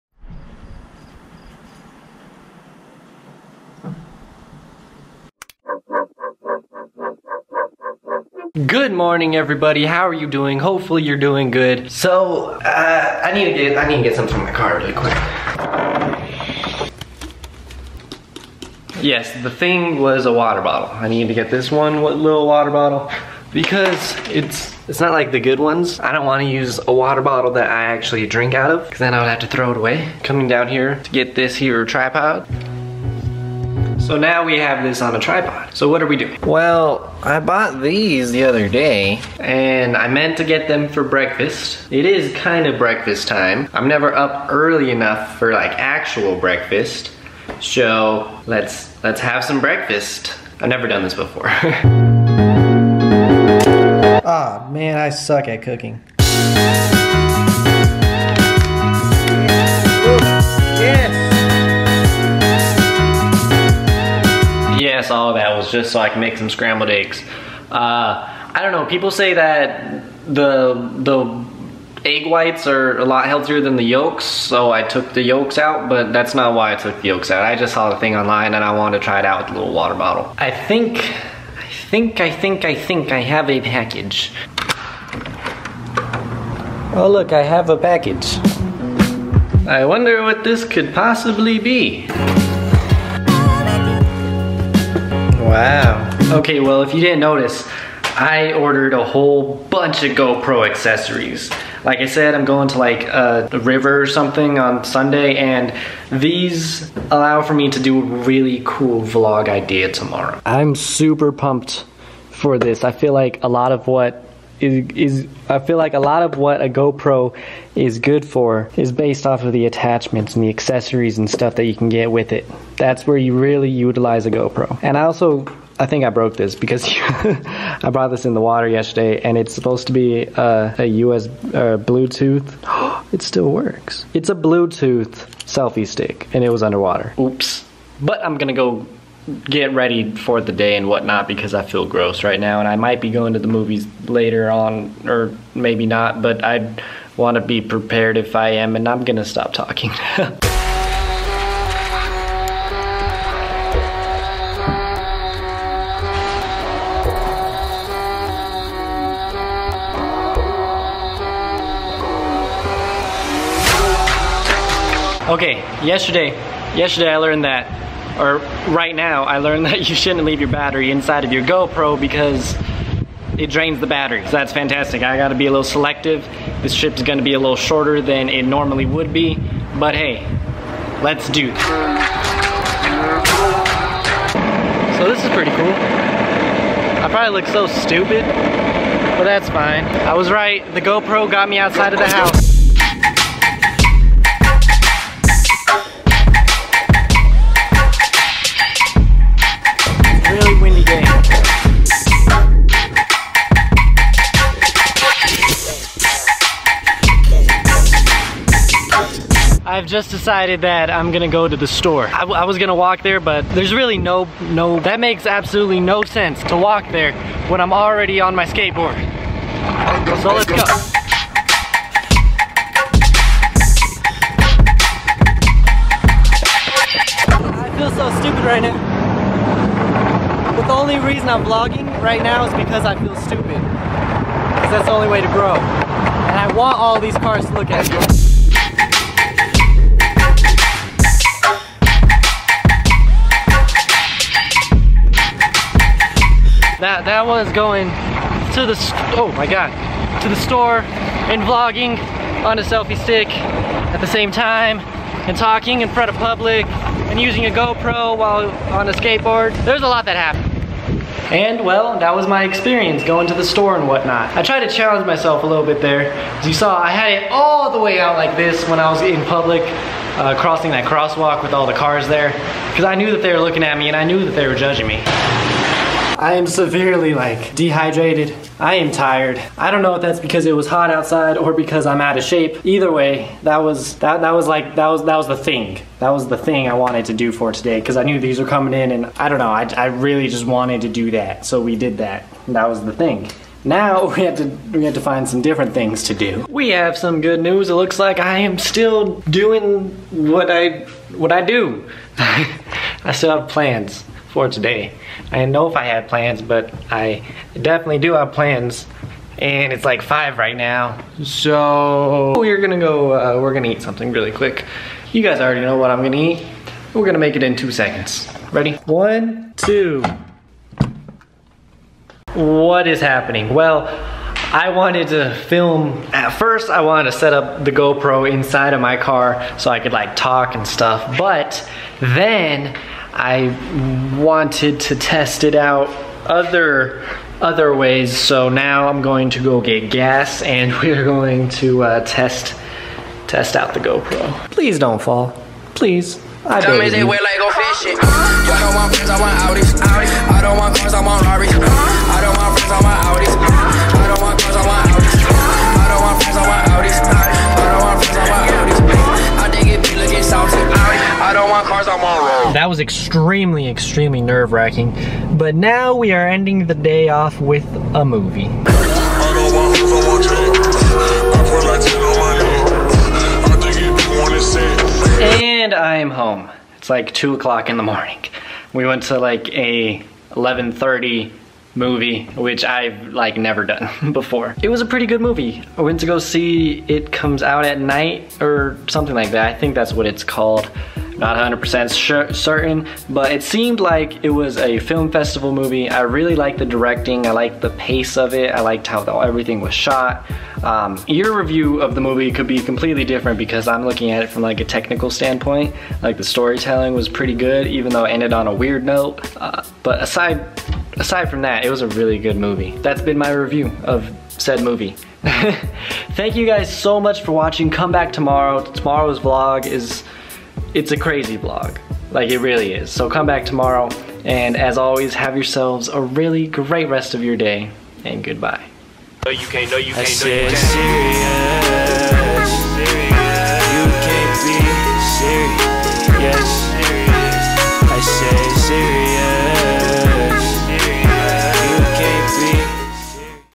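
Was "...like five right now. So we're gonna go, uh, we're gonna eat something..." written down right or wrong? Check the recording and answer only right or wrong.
right.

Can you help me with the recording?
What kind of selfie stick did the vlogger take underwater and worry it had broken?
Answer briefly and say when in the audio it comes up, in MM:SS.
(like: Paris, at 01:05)
Bluetooth selfie stick, at 02:14.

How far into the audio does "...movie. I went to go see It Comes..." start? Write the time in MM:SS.
06:25.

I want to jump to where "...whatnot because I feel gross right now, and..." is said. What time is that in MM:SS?
02:20.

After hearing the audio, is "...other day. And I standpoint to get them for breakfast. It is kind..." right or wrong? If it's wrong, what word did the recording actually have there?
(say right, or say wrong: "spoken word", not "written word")
wrong: "meant", not "standpoint".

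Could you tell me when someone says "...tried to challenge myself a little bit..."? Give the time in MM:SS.
04:24.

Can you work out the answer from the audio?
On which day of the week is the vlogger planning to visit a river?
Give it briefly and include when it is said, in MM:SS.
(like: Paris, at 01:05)
Sunday, at 01:44.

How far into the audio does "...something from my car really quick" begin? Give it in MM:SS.
00:14.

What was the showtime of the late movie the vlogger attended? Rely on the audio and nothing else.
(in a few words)
11:30.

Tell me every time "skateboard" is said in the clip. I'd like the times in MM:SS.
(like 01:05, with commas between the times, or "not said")
03:38, 04:18.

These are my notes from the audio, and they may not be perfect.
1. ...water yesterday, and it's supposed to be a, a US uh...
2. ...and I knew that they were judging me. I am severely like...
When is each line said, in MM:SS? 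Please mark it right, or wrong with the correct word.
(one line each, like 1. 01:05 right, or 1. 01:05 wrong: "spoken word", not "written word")
1. 02:08 right
2. 04:33 right.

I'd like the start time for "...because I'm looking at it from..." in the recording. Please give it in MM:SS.
06:43.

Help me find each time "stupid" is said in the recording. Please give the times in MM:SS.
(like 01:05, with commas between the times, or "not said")
03:07, 03:48, 03:53.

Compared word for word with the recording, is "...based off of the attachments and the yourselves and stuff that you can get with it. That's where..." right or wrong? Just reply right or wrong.
wrong.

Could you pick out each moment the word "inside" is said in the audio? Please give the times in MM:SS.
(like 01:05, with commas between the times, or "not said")
02:50, 05:28.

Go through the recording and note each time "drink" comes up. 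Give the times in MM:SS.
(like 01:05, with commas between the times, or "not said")
00:28.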